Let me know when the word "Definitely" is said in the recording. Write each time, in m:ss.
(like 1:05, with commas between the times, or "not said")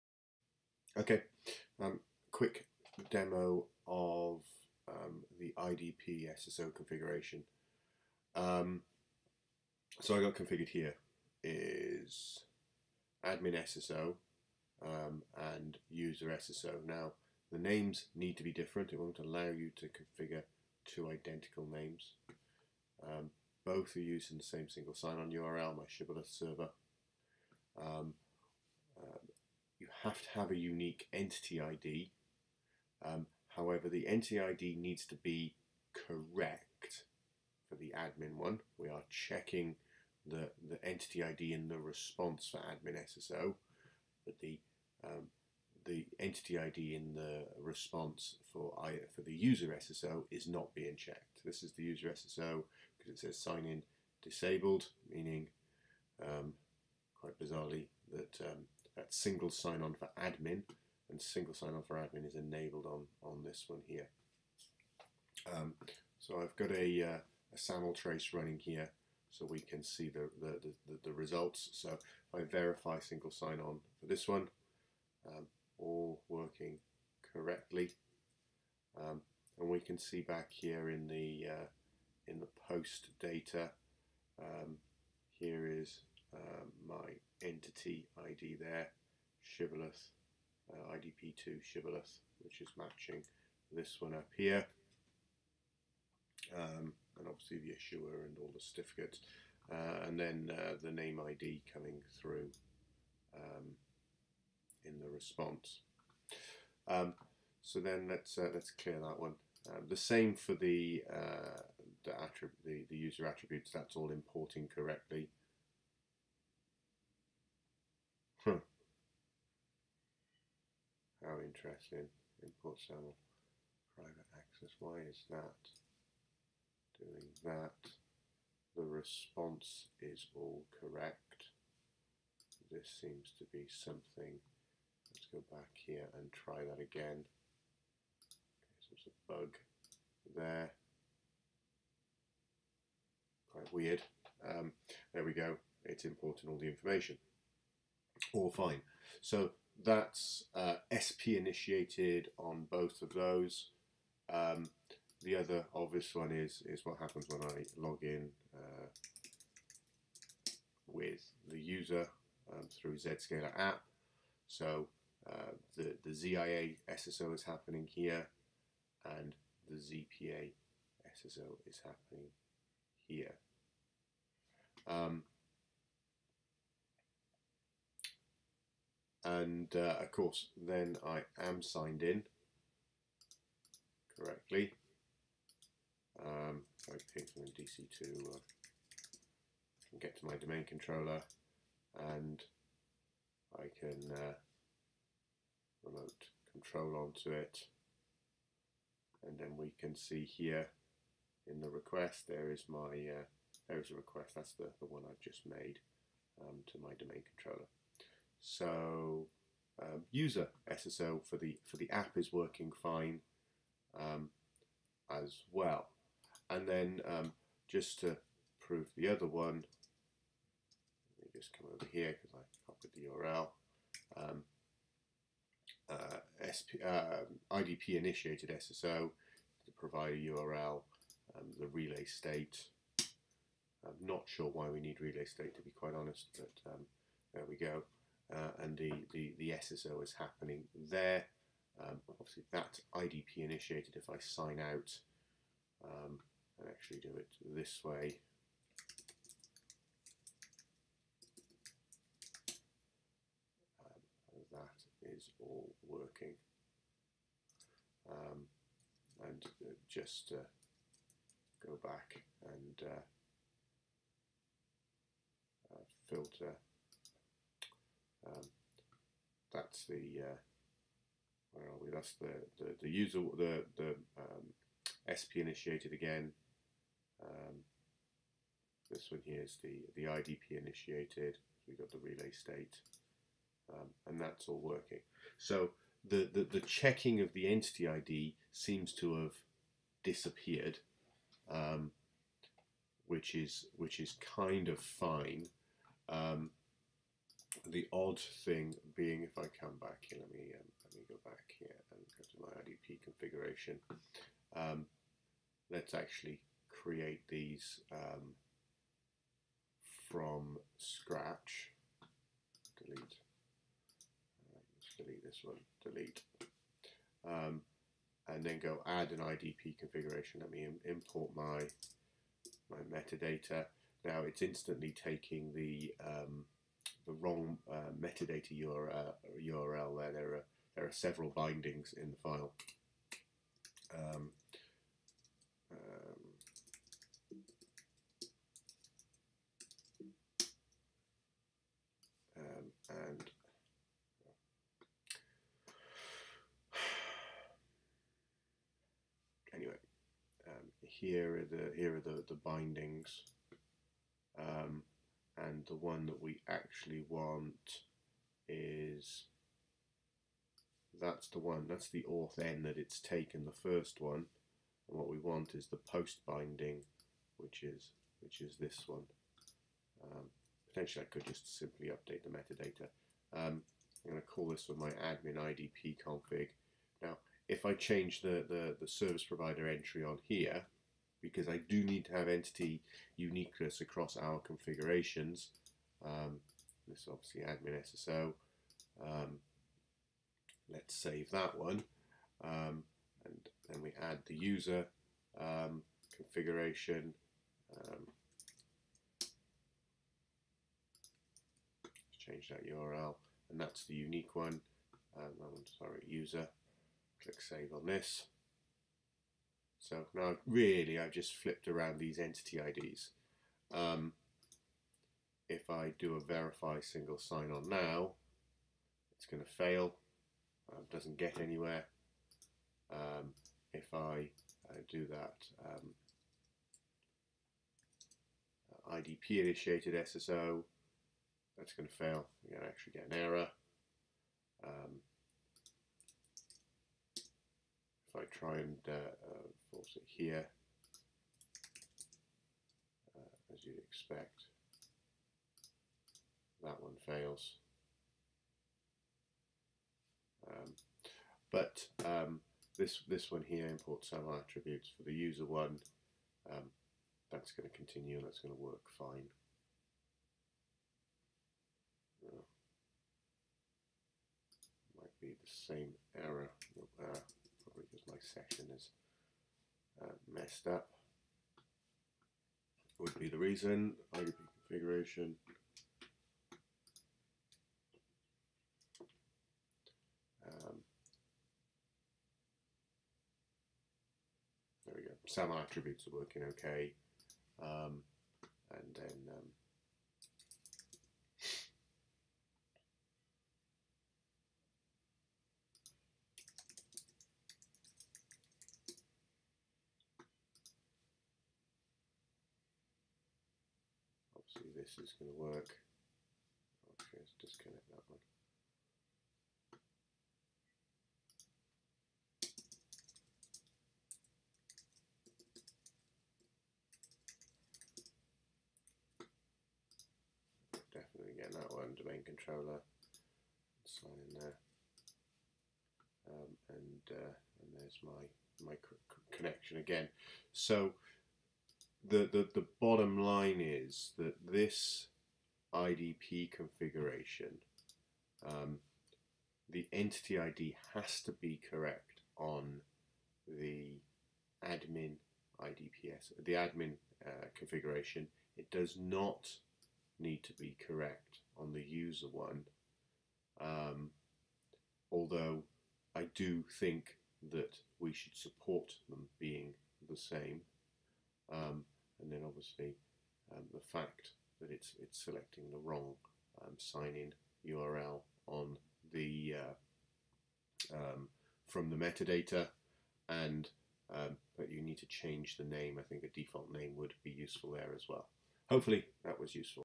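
8:40.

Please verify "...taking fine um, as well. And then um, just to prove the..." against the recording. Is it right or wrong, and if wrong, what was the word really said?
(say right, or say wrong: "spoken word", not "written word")
wrong: "working", not "taking".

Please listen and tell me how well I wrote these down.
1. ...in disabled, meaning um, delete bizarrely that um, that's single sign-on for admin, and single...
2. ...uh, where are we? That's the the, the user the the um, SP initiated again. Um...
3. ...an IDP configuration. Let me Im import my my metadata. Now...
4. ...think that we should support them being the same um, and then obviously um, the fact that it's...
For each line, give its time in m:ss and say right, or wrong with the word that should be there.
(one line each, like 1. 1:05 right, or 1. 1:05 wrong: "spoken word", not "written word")
1. 0:53 wrong: "quite", not "delete"
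2. 4:30 right
3. 5:19 right
4. 9:16 right.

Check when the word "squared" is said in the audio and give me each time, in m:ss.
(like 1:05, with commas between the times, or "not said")
not said.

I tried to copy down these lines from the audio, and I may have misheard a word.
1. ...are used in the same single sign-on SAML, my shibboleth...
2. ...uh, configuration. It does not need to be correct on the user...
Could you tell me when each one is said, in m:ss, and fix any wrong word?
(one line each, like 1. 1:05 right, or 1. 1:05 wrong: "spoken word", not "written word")
1. 0:23 wrong: "URL", not "SAML"
2. 9:07 right.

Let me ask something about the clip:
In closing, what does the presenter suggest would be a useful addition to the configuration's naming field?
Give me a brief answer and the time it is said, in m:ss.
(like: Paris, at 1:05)
a default name, at 9:36.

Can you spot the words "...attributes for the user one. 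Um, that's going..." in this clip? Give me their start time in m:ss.
7:34.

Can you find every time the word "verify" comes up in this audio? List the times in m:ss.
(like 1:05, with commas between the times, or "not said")
1:12, 6:56.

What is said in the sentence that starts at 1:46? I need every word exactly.
Um, so then let's uh, let's clear that one.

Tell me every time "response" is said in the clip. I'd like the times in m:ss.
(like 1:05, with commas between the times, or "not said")
0:41, 0:47, 1:45, 2:08.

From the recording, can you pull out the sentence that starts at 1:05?
Um, so I've got a, uh, a SAML trace running here so we can see the, the, the, the results.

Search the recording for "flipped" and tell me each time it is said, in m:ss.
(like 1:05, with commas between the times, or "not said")
6:51.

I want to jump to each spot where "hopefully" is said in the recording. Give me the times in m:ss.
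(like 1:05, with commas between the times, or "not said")
9:38.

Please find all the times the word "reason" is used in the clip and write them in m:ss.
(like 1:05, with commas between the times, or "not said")
7:53.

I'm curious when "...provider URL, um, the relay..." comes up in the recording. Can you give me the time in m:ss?
3:49.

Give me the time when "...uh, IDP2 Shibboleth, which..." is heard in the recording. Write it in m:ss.
1:30.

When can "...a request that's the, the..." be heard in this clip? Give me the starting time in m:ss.
3:23.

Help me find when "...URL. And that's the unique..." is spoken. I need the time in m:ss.
6:42.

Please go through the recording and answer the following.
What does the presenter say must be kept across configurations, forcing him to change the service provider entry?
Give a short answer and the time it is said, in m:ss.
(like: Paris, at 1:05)
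entity uniqueness, at 6:22.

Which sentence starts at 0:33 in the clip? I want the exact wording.
Um, however, the entity ID needs to be correct for the admin one.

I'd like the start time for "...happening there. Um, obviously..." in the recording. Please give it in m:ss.
4:00.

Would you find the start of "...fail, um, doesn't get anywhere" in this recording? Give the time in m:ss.
6:59.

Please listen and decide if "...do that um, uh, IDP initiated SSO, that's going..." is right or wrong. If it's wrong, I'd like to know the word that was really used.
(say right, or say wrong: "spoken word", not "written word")
right.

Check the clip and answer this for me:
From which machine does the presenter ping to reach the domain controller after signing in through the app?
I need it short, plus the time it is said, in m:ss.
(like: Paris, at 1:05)
DC2, at 3:07.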